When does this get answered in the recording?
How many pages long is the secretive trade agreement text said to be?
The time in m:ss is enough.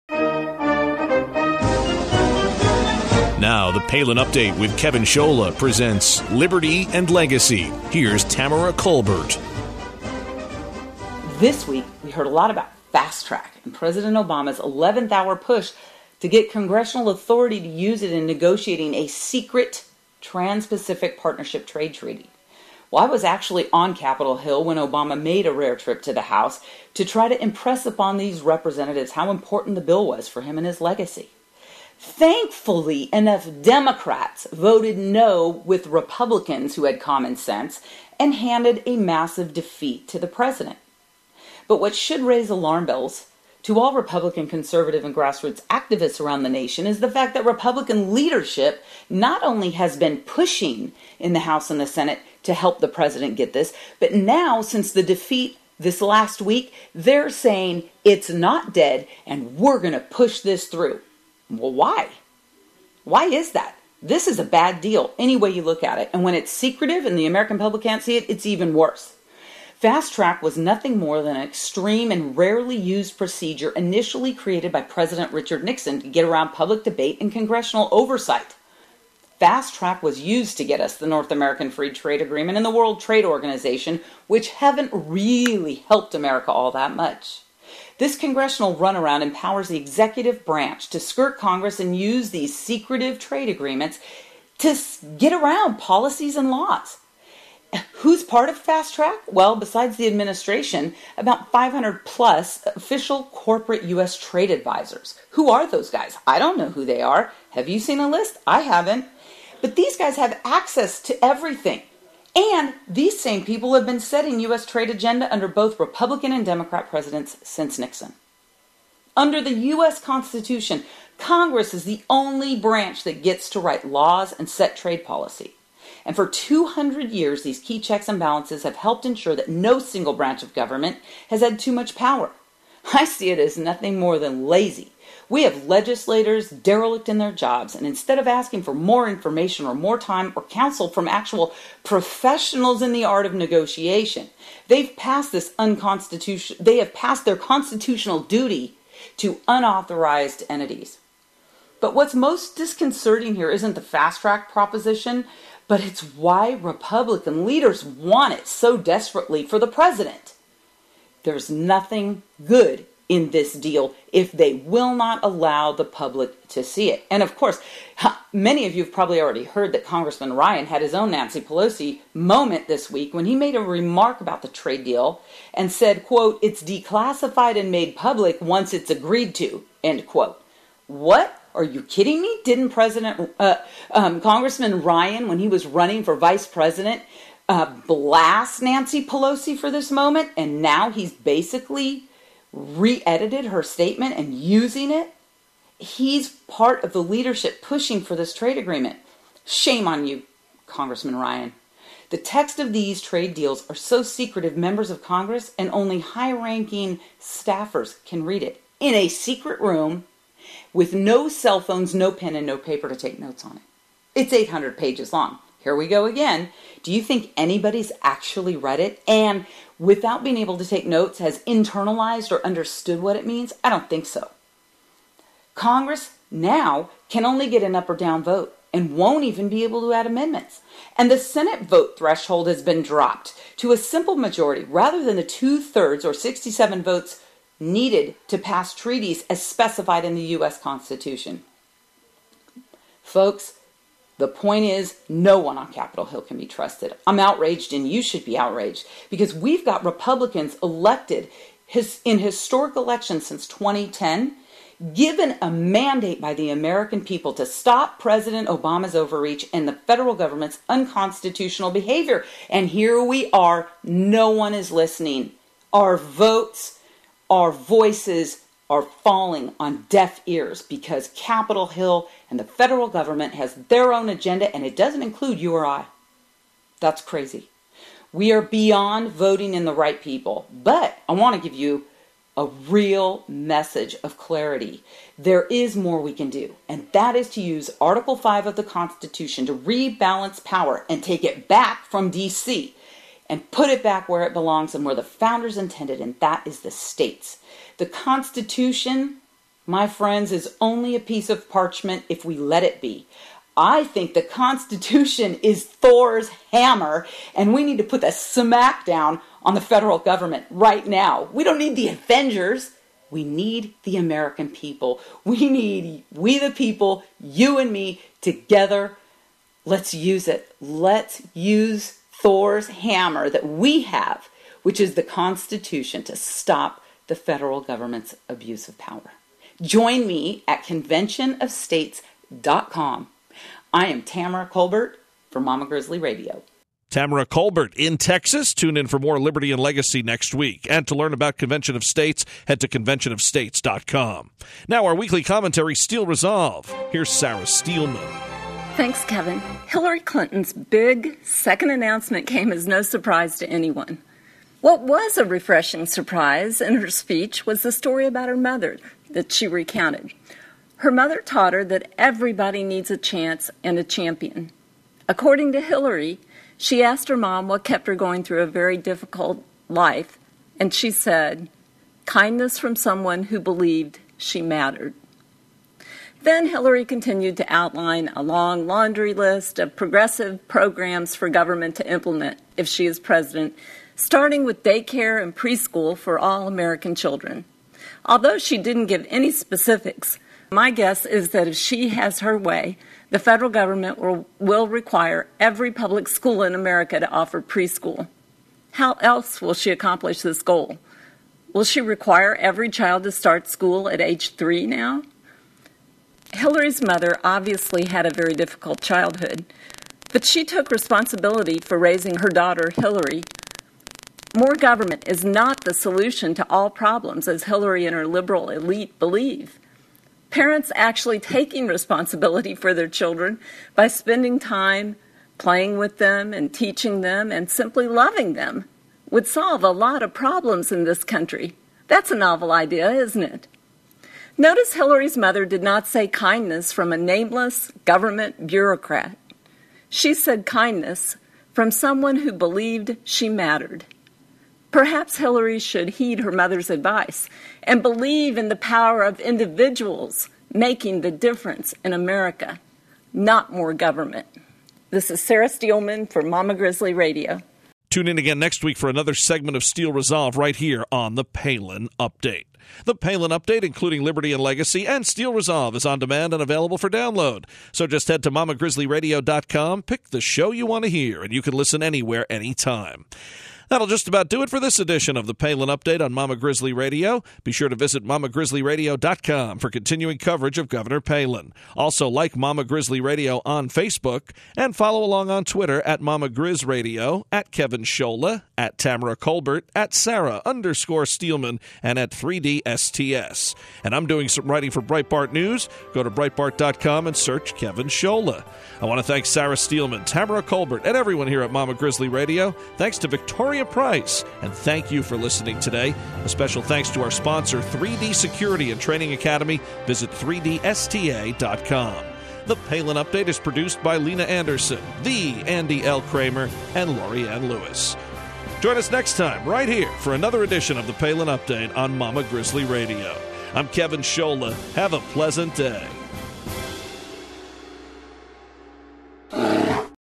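3:34.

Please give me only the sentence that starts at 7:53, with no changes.
That'll just about do it for this edition of the Palin Update on Mama Grizzly Radio.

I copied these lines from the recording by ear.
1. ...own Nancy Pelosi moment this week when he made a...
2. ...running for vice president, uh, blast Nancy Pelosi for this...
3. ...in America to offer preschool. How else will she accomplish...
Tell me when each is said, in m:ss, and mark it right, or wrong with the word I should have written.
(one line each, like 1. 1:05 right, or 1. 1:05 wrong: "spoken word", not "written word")
1. 2:50 right
2. 3:05 right
3. 6:36 right.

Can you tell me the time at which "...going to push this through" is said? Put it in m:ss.
0:59.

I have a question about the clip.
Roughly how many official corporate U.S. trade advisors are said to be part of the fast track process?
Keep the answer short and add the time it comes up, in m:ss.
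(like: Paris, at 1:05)
500, at 1:41.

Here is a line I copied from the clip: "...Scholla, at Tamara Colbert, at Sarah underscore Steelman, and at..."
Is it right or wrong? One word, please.
right.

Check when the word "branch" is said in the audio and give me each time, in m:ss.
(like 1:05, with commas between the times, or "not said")
1:30, 2:02, 2:10.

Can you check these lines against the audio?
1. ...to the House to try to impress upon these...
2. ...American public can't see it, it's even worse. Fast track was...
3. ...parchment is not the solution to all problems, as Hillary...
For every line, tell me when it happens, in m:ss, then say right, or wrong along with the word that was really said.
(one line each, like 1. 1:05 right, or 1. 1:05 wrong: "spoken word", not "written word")
1. 0:26 right
2. 1:07 right
3. 6:54 wrong: "government", not "parchment".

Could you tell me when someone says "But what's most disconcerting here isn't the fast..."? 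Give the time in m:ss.
2:31.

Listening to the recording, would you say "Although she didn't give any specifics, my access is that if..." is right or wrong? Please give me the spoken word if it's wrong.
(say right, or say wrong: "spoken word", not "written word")
wrong: "guess", not "access".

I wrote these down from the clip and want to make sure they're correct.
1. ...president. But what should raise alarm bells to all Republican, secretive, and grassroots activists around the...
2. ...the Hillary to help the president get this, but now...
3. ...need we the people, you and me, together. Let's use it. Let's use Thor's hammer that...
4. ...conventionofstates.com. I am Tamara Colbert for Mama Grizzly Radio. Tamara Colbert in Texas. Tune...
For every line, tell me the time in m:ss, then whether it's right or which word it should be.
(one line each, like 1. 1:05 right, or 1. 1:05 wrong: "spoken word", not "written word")
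1. 0:40 wrong: "conservative", not "secretive"
2. 0:51 wrong: "Senate", not "Hillary"
3. 5:15 right
4. 5:30 right.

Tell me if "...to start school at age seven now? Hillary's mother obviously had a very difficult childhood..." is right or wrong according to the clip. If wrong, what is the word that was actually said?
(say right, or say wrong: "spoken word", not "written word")
wrong: "three", not "seven".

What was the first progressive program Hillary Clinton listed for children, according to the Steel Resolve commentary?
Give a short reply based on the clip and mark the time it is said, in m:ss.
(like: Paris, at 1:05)
daycare and preschool, at 6:24.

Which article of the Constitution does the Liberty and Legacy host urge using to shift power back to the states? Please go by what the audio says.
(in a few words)
Article 5.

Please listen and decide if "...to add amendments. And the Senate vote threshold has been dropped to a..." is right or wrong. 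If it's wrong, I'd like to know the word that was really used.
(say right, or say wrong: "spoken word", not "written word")
right.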